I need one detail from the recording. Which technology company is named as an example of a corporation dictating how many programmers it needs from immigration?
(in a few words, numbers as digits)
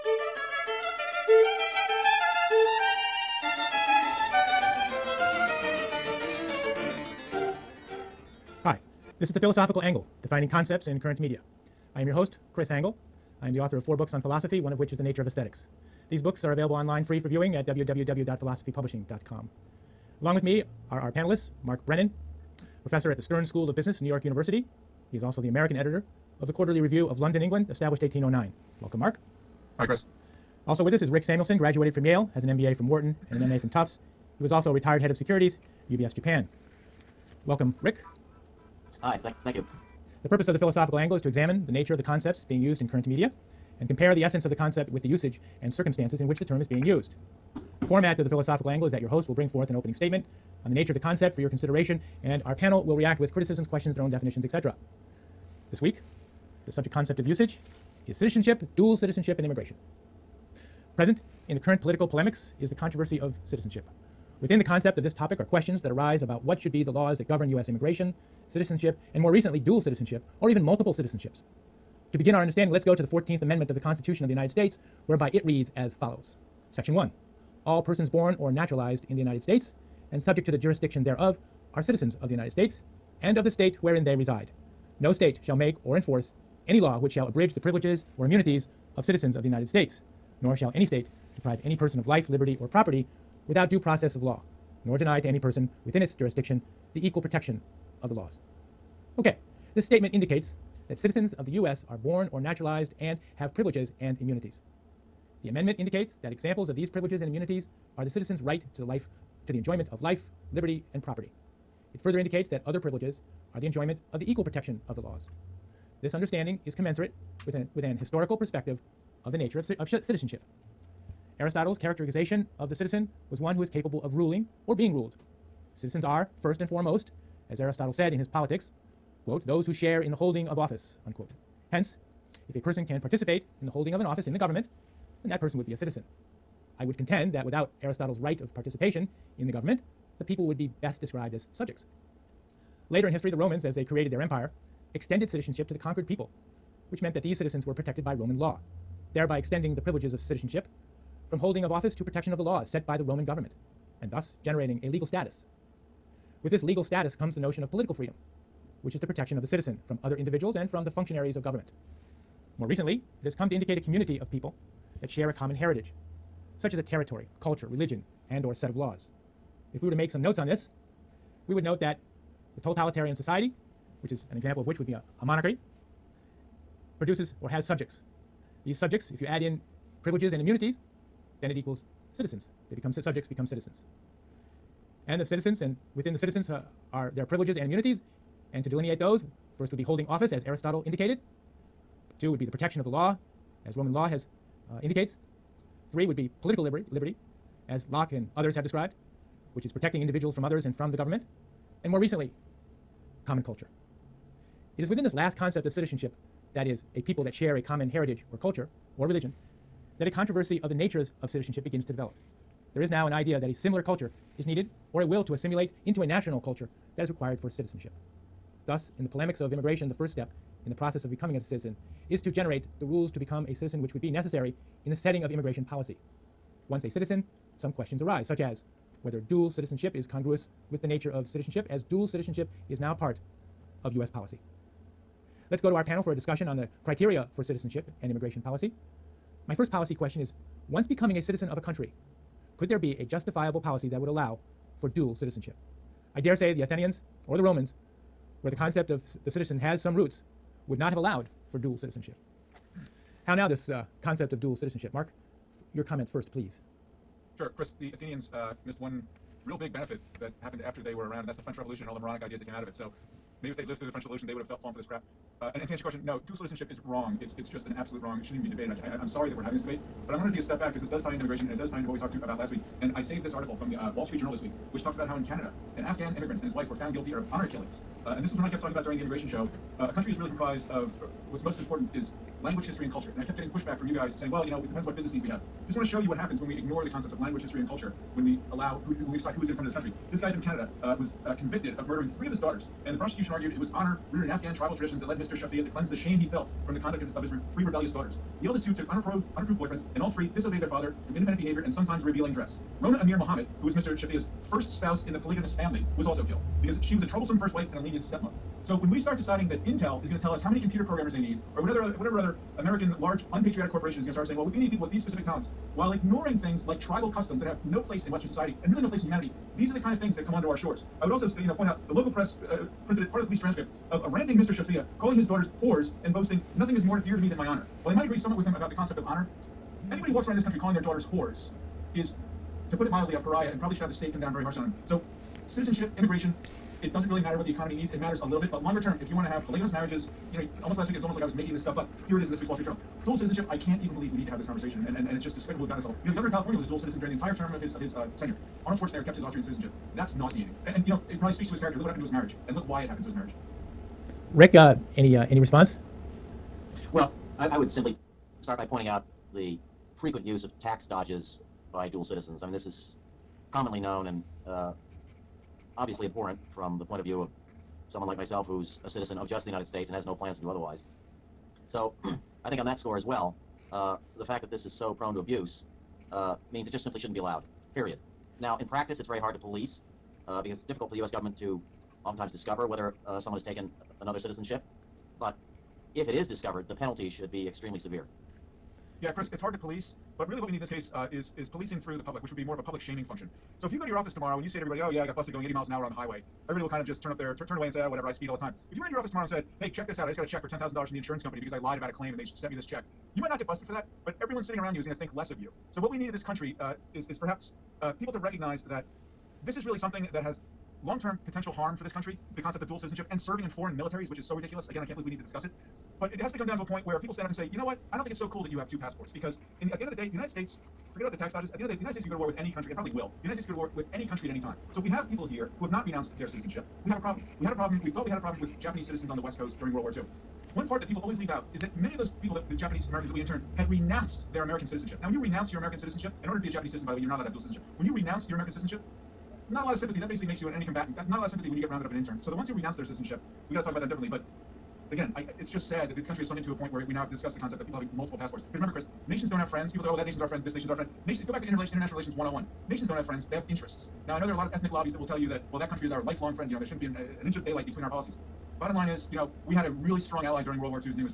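Intel.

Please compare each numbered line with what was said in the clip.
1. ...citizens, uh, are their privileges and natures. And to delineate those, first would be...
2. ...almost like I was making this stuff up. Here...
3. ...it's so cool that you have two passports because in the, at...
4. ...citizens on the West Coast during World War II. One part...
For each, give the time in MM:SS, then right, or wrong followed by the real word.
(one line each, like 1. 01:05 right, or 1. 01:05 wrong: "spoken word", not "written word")
1. 03:06 wrong: "immunities", not "natures"
2. 05:41 right
3. 06:58 right
4. 07:08 right.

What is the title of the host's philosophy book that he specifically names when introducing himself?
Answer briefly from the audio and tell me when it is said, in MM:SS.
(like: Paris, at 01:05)
The Nature of Aesthetics, at 00:14.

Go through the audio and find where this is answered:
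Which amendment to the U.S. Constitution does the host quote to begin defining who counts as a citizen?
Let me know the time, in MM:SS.
01:13.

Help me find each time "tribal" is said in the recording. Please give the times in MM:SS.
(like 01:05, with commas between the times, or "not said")
04:54, 05:16.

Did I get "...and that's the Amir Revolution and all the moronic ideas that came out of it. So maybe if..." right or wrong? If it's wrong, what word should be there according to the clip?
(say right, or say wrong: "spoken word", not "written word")
wrong: "French", not "Amir".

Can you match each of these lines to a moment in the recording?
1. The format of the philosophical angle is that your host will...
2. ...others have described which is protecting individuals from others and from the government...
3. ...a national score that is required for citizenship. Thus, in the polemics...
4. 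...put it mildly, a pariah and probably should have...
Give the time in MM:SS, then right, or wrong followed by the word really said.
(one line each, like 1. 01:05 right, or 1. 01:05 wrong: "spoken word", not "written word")
1. 00:47 right
2. 03:18 right
3. 03:36 wrong: "culture", not "score"
4. 05:32 right.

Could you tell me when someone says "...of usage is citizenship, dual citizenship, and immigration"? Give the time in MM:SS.
00:57.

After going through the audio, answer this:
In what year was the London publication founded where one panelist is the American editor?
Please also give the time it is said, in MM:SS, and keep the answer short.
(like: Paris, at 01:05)
1809, at 00:28.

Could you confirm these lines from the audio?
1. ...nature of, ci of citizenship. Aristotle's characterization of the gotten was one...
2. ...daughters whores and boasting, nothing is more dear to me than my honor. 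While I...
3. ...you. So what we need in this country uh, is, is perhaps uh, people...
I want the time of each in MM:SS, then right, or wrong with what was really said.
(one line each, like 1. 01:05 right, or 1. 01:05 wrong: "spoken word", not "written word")
1. 01:59 wrong: "citizen", not "gotten"
2. 05:25 right
3. 06:45 right.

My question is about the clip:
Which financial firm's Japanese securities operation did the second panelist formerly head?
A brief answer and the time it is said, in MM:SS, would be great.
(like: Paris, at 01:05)
UBS, at 00:35.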